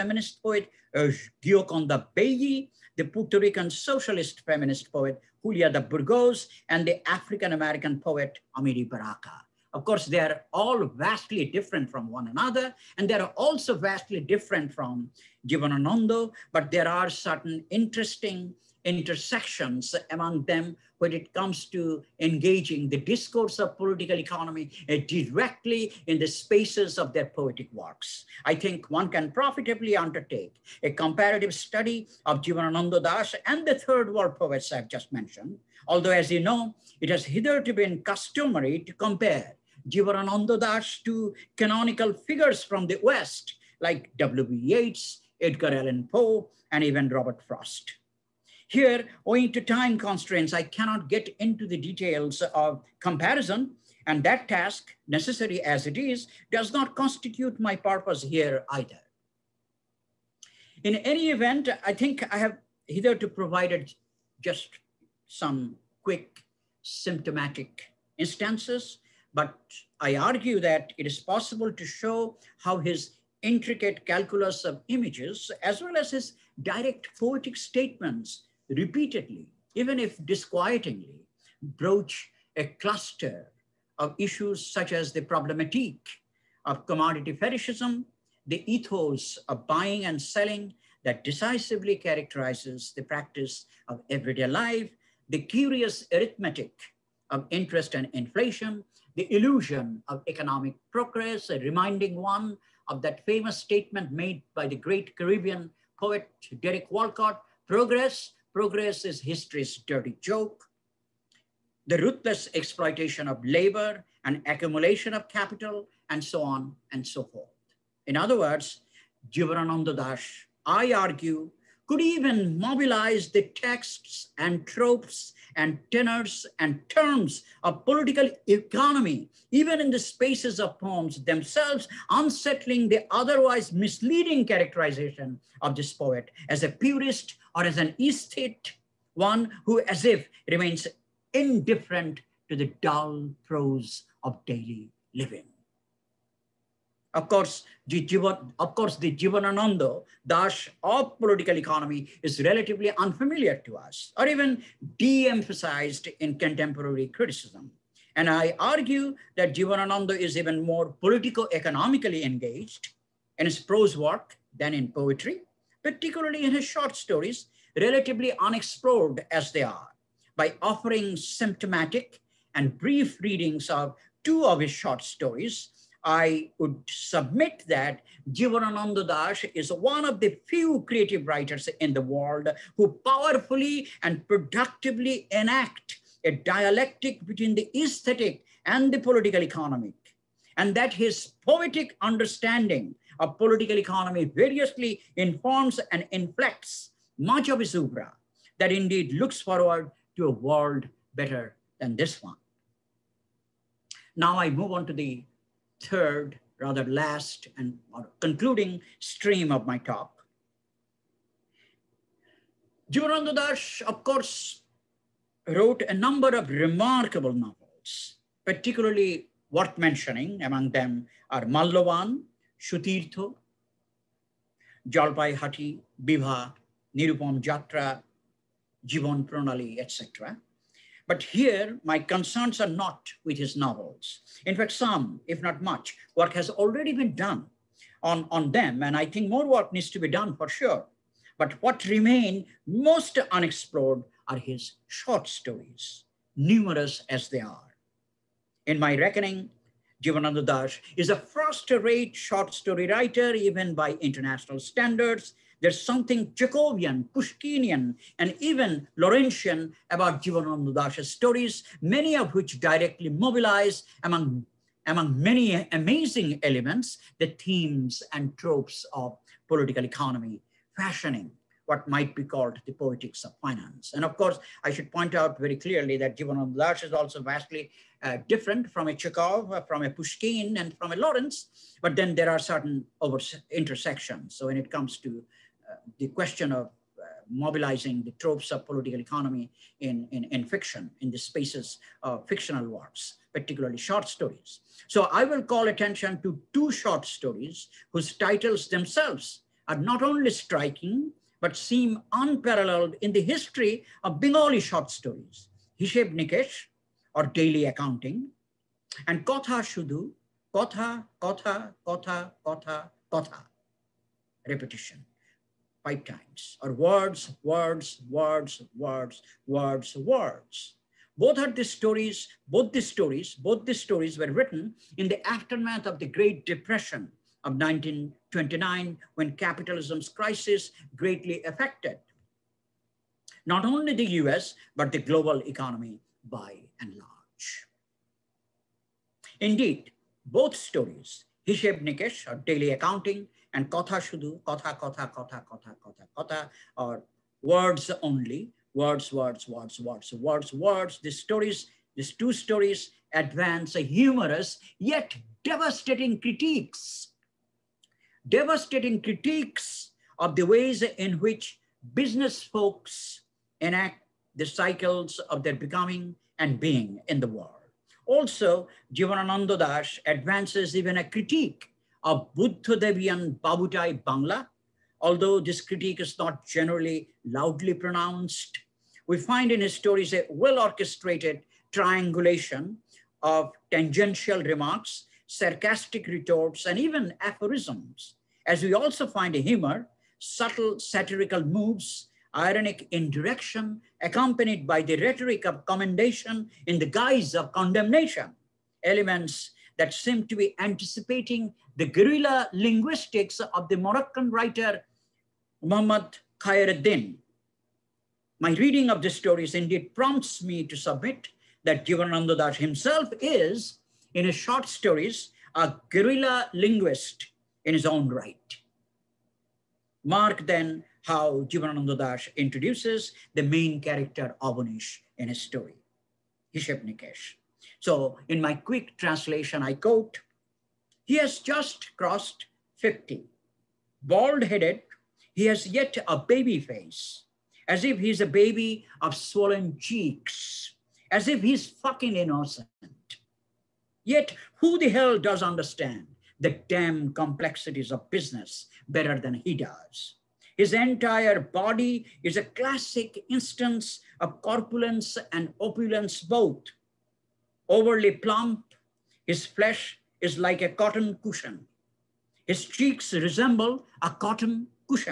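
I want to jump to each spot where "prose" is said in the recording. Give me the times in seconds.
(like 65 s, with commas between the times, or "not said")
143 s, 163 s.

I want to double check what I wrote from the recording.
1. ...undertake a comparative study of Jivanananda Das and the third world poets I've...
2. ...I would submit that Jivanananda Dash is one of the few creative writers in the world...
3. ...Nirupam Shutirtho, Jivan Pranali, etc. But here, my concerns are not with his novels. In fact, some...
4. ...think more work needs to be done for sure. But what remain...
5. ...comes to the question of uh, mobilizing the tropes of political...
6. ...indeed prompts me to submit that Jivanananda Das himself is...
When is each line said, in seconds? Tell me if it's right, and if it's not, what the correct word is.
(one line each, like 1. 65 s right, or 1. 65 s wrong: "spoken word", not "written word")
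1. 29 s right
2. 176 s right
3. 226 s wrong: "Jatra", not "Shutirtho"
4. 239 s right
5. 284 s right
6. 409 s right.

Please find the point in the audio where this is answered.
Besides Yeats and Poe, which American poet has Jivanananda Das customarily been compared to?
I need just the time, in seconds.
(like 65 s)
47 s.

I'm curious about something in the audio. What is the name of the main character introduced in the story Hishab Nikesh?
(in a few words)
Avanish.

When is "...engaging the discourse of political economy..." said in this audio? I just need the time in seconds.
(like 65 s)
22 s.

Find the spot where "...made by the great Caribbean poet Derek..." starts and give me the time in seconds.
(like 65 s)
104 s.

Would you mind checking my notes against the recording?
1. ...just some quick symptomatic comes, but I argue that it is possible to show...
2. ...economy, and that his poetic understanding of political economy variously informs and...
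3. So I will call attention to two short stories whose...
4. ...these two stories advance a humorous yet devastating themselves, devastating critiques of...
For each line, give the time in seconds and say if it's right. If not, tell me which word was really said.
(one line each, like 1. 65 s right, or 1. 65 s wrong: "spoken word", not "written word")
1. 64 s wrong: "instances", not "comes"
2. 189 s right
3. 294 s right
4. 351 s wrong: "critiques", not "themselves".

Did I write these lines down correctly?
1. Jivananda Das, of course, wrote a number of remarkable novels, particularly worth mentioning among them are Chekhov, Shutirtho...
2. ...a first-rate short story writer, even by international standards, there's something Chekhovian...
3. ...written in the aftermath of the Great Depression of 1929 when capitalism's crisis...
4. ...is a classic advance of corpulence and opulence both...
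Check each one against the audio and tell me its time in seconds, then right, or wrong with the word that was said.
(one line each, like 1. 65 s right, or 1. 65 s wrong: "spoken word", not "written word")
1. 212 s wrong: "Mallavan", not "Chekhov"
2. 251 s right
3. 324 s right
4. 452 s wrong: "instance", not "advance".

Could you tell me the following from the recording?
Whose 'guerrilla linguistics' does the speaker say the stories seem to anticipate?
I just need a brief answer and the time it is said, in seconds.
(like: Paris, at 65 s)
Muhammad Khayreddin, at 405 s.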